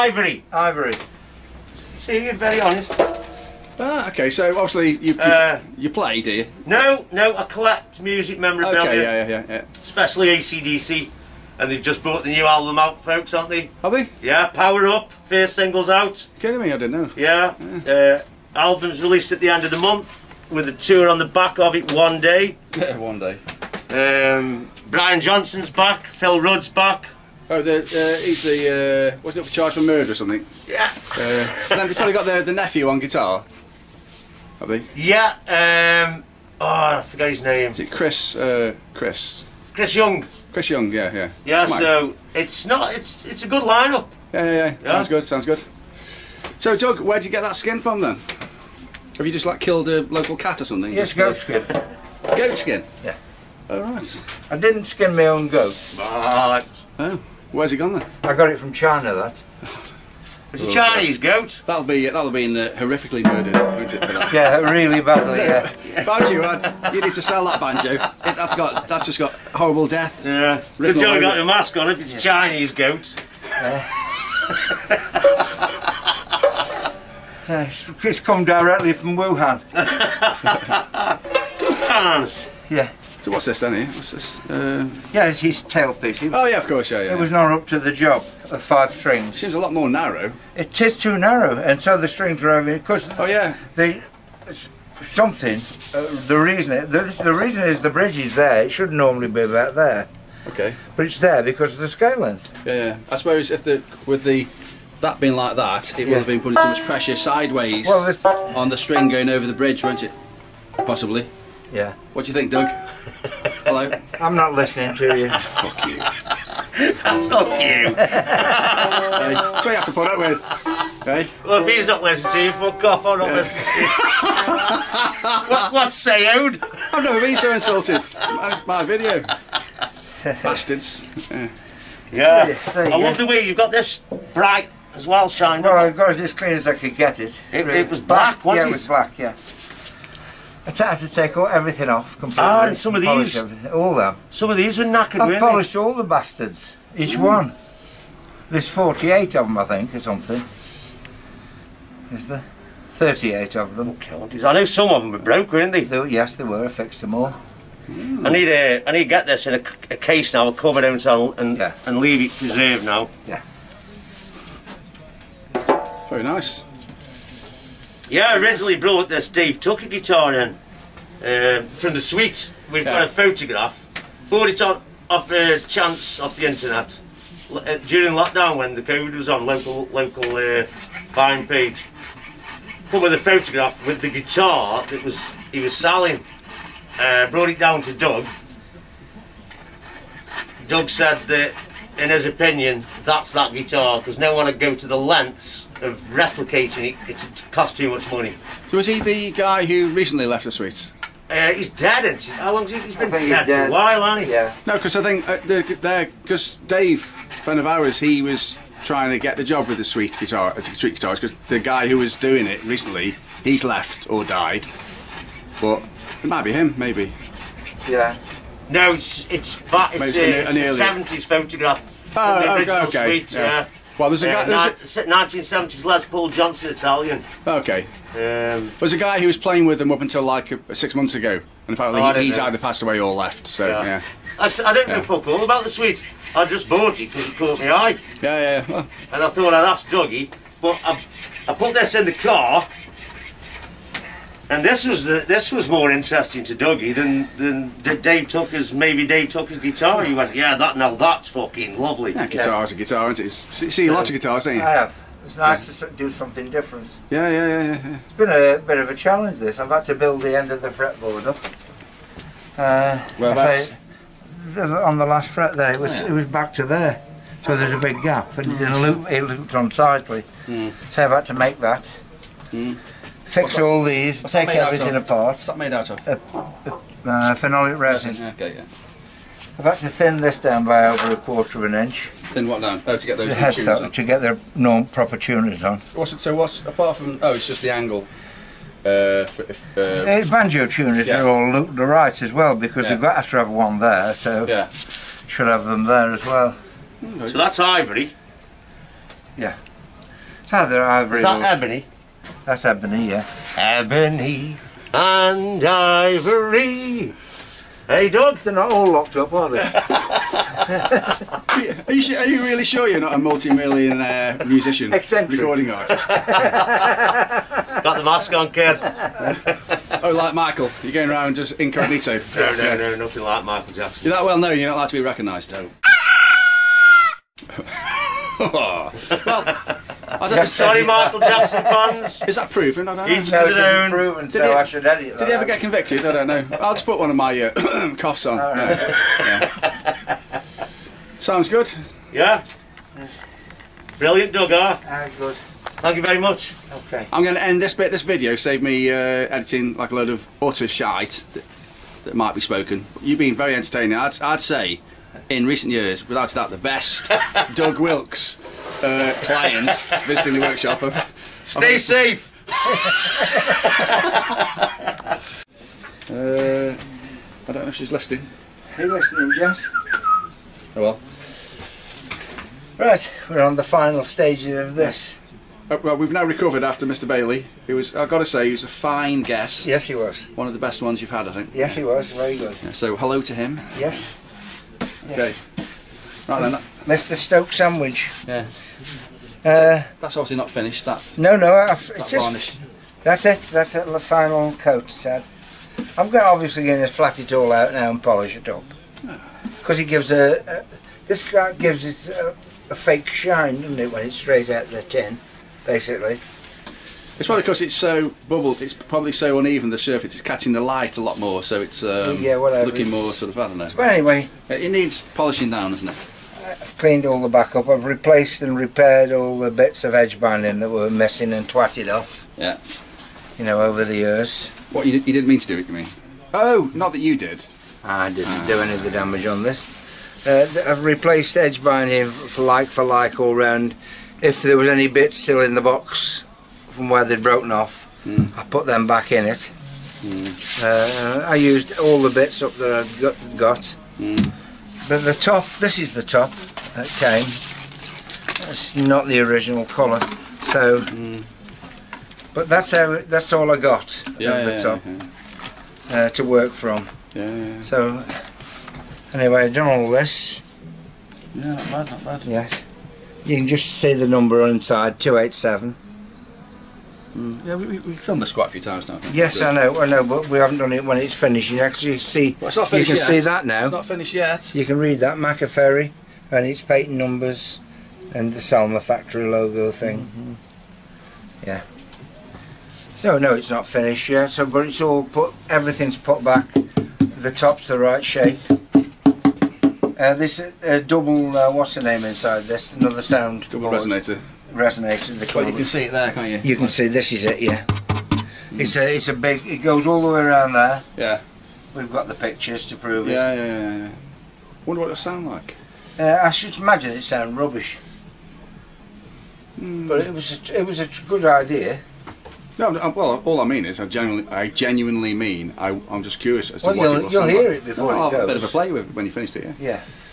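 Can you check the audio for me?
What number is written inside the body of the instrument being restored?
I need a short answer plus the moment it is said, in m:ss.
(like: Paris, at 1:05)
287, at 7:44.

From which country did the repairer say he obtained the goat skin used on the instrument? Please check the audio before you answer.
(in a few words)
China.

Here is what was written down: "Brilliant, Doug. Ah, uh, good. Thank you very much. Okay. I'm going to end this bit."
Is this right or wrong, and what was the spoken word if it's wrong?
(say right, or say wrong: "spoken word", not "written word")
right.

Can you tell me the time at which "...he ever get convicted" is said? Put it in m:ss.
5:35.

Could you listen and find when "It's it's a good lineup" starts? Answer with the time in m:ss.
0:42.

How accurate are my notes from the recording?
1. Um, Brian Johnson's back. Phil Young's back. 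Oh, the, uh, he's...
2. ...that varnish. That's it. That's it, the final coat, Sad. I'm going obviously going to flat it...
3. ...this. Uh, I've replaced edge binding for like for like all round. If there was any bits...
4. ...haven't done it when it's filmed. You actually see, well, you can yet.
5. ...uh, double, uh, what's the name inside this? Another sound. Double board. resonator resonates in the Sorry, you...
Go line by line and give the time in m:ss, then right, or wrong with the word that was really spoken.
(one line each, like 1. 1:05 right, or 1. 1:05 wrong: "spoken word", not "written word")
1. 0:23 wrong: "Rudd", not "Young"
2. 6:31 right
3. 7:09 right
4. 7:50 wrong: "finished", not "filmed"
5. 8:10 wrong: "Well", not "Sorry".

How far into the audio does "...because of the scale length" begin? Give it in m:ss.
1:41.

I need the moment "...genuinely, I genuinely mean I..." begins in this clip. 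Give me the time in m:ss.
8:33.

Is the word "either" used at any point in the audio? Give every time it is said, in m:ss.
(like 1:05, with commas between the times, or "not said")
3:52, 5:00.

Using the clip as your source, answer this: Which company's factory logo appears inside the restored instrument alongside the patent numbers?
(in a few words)
Selmer.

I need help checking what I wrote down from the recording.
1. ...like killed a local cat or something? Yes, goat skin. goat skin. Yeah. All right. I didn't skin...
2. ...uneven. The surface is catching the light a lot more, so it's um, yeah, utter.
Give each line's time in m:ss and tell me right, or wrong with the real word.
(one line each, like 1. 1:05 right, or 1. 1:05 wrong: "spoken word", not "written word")
1. 0:49 right
2. 6:49 wrong: "whatever", not "utter".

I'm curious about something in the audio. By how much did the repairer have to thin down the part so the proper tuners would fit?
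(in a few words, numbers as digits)
Over a quarter of an inch.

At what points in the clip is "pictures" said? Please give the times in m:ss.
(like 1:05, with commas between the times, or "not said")
8:22.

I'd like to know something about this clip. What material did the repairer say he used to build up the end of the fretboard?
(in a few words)
Phenolic resin.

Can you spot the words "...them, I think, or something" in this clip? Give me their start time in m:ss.
2:29.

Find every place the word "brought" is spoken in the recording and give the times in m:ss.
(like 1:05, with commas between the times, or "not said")
0:12, 2:48, 3:07.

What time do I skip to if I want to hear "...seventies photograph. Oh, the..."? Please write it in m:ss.
3:40.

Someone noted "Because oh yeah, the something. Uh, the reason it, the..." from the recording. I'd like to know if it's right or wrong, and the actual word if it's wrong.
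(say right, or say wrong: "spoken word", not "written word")
right.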